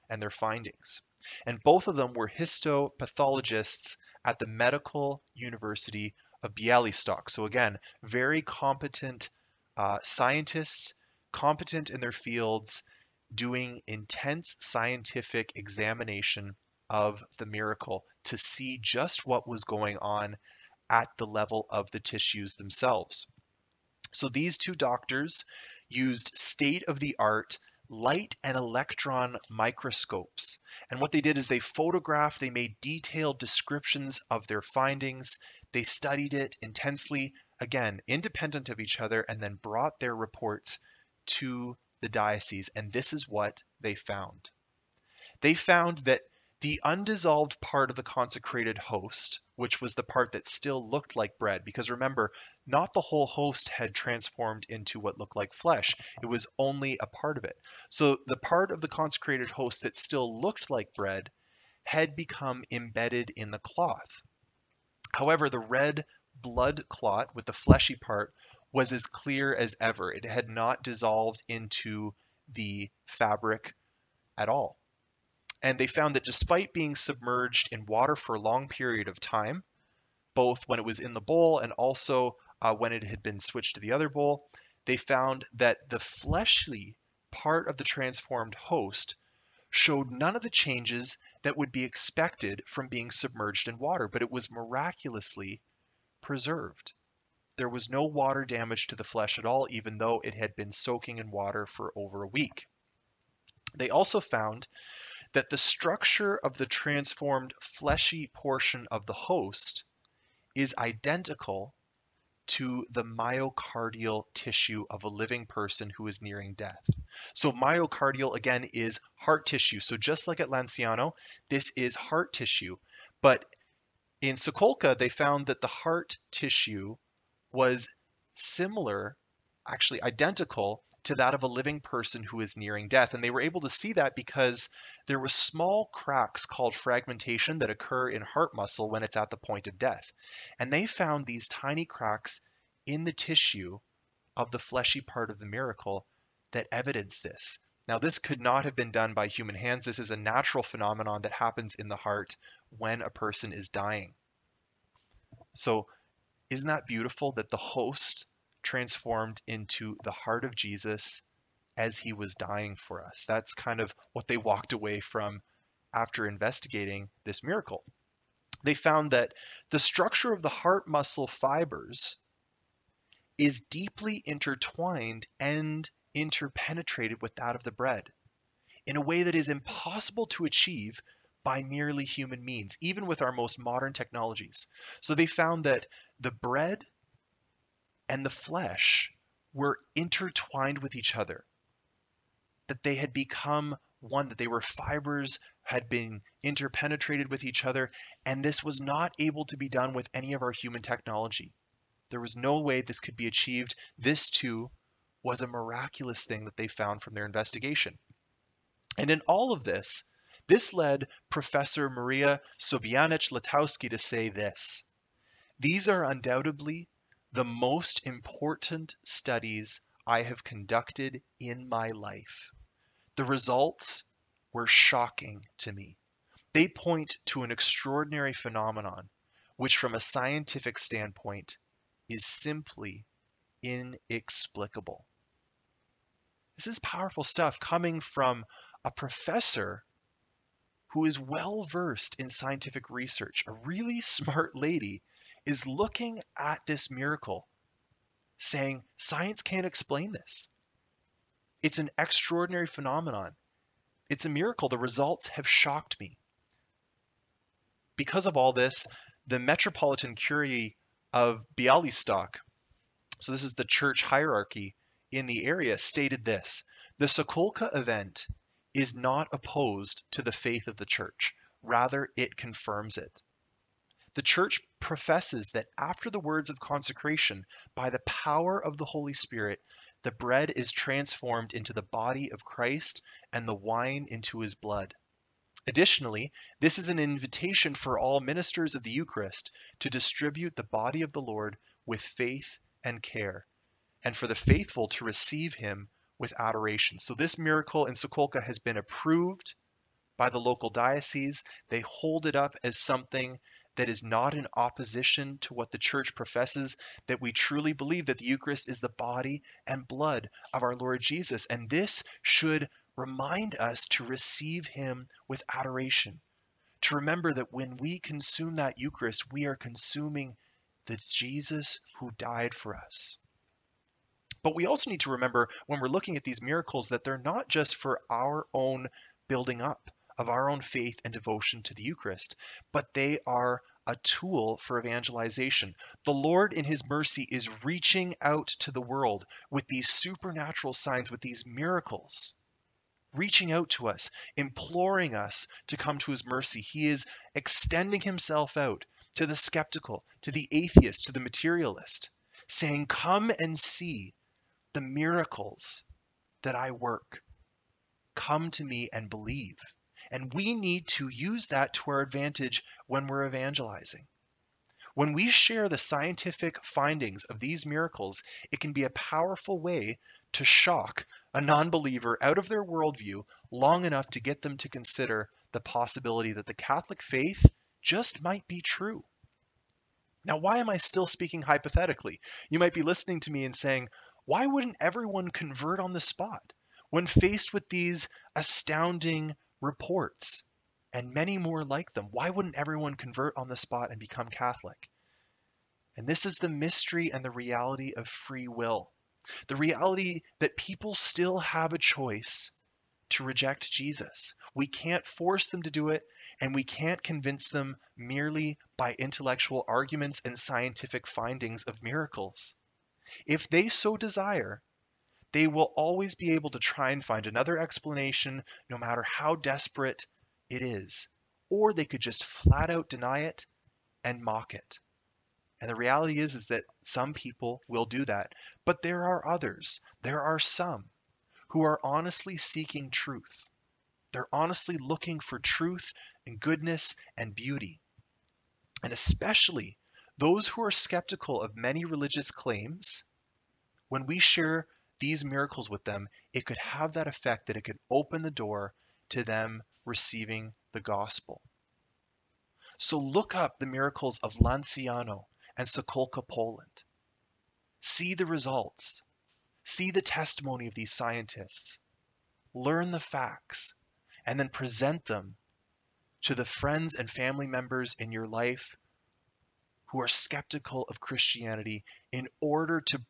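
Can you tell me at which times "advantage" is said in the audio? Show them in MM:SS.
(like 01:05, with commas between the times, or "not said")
06:01.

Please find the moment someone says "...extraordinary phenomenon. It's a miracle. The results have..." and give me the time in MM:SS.
04:11.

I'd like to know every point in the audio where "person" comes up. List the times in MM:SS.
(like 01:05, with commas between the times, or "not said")
01:55, 02:11, 02:33.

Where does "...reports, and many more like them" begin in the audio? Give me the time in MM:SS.
06:29.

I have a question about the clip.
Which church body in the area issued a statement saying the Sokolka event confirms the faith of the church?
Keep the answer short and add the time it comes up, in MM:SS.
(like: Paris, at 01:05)
Metropolitan Curia of Bialystok, at 04:19.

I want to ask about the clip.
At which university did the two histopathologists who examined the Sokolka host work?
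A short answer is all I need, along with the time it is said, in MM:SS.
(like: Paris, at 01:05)
Medical University of Bialystok, at 00:04.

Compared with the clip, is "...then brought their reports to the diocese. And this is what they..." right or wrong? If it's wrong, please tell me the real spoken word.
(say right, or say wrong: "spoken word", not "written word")
right.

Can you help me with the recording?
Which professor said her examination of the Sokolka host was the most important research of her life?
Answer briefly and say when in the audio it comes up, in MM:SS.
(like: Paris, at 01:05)
Maria Sobaniec Łotowski, at 03:31.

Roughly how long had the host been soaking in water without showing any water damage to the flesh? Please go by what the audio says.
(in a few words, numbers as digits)
Over a week.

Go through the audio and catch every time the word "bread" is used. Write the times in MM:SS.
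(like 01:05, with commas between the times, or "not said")
00:51, 01:00, 02:57, 03:06, 04:40.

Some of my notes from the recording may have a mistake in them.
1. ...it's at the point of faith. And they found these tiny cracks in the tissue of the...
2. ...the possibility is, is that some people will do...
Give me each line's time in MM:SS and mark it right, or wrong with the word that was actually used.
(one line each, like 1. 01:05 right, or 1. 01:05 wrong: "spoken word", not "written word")
1. 02:19 wrong: "death", not "faith"
2. 07:05 wrong: "reality", not "possibility".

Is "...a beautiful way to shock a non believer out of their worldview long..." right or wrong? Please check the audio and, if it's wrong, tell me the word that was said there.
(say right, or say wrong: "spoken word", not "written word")
wrong: "powerful", not "beautiful".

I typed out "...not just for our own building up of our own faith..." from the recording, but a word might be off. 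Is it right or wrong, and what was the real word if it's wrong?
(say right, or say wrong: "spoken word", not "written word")
right.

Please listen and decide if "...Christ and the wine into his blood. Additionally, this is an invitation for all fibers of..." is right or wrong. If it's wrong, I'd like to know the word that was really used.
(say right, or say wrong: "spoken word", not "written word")
wrong: "ministers", not "fibers".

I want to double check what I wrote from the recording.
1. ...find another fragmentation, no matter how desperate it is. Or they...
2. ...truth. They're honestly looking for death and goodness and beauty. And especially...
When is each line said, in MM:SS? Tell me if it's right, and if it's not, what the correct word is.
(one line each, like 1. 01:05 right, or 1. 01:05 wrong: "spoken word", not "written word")
1. 06:57 wrong: "explanation", not "fragmentation"
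2. 07:12 wrong: "truth", not "death".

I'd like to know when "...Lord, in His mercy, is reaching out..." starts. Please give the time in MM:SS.
05:36.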